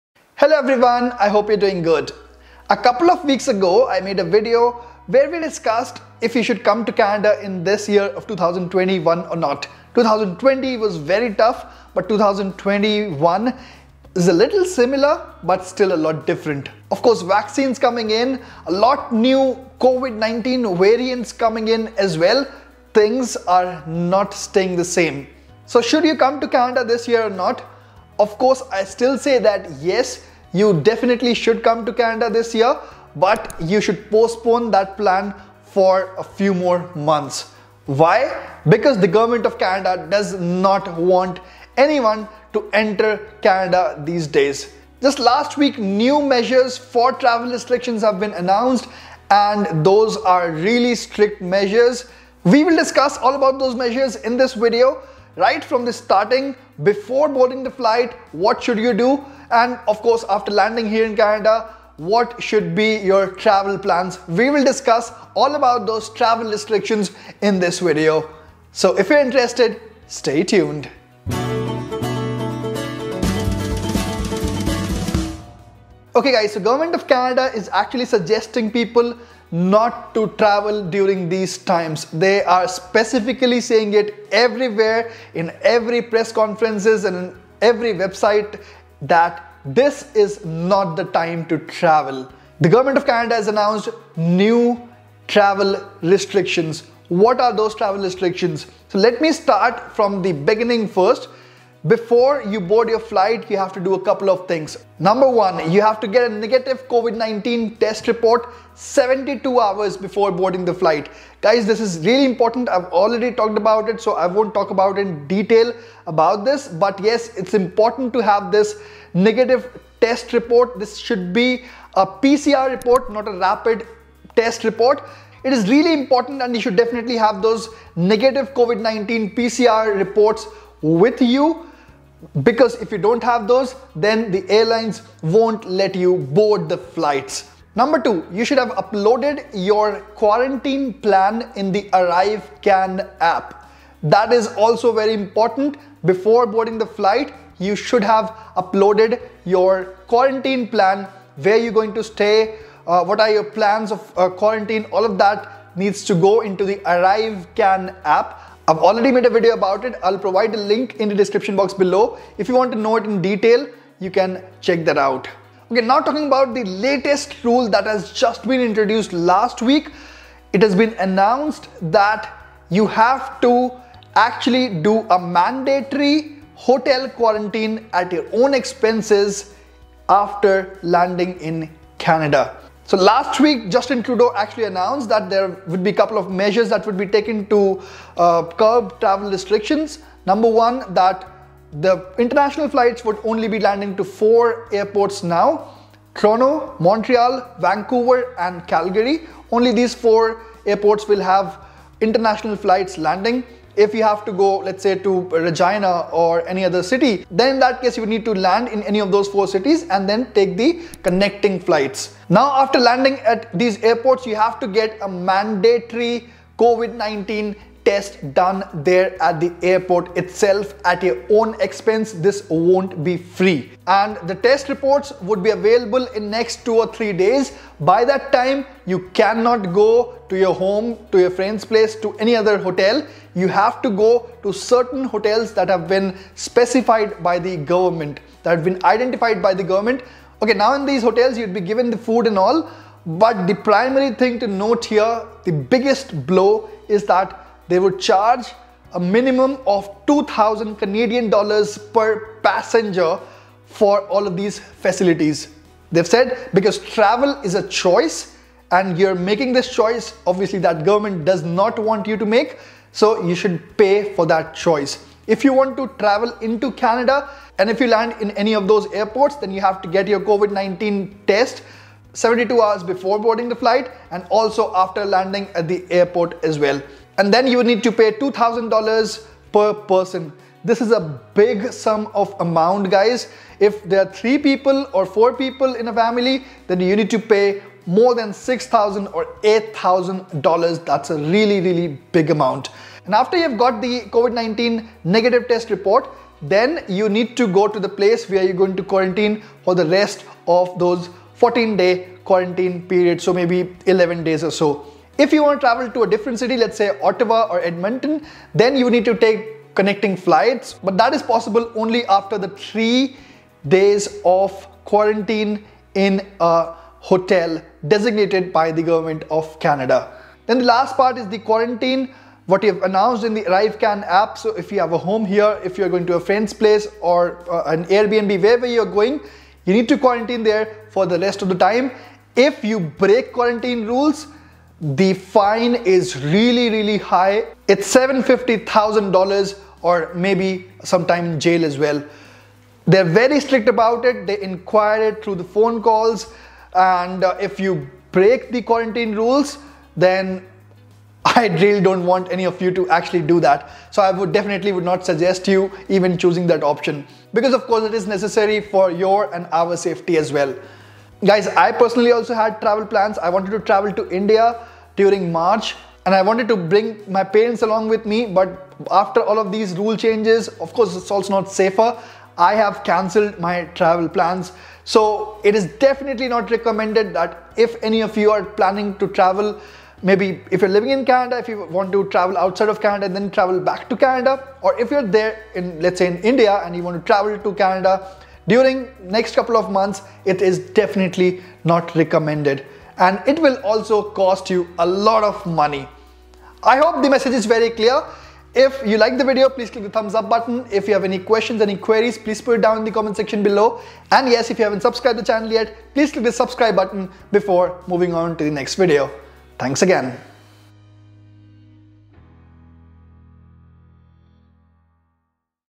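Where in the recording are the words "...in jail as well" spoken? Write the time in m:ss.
5:41.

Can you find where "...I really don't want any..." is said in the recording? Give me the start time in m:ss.
5:51.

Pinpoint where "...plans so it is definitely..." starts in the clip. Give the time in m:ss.
6:14.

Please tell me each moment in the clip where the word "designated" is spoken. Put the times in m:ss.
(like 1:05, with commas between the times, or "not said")
5:17.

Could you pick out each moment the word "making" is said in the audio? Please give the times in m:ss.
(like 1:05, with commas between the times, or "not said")
4:19.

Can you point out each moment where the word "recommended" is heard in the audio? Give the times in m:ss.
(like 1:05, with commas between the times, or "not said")
6:16, 6:31.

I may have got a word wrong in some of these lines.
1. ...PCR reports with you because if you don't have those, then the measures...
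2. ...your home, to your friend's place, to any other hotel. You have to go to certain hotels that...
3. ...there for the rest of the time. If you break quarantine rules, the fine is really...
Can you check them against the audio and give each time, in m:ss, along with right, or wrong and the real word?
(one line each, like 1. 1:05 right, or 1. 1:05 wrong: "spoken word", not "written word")
1. 2:09 wrong: "airlines", not "measures"
2. 3:50 right
3. 5:30 right.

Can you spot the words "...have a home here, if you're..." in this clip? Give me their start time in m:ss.
5:24.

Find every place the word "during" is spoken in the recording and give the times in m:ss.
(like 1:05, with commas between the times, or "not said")
1:20, 6:04, 6:28.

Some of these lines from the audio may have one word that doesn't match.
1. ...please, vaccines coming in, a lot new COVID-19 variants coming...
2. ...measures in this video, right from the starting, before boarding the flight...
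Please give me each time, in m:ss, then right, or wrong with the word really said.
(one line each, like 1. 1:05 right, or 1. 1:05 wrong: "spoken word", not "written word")
1. 0:17 wrong: "course", not "please"
2. 0:53 right.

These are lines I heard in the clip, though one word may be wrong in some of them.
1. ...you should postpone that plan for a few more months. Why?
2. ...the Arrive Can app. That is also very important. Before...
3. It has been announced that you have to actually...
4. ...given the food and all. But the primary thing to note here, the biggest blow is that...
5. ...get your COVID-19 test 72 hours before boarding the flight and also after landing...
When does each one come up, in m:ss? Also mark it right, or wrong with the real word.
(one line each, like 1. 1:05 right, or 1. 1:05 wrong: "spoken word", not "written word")
1. 0:33 right
2. 2:21 right
3. 2:50 right
4. 4:01 right
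5. 4:29 right.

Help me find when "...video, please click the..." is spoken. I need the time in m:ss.
6:39.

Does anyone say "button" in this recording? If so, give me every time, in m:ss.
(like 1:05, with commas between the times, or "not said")
6:40, 6:46.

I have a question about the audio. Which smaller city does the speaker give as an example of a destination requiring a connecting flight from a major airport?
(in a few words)
Regina.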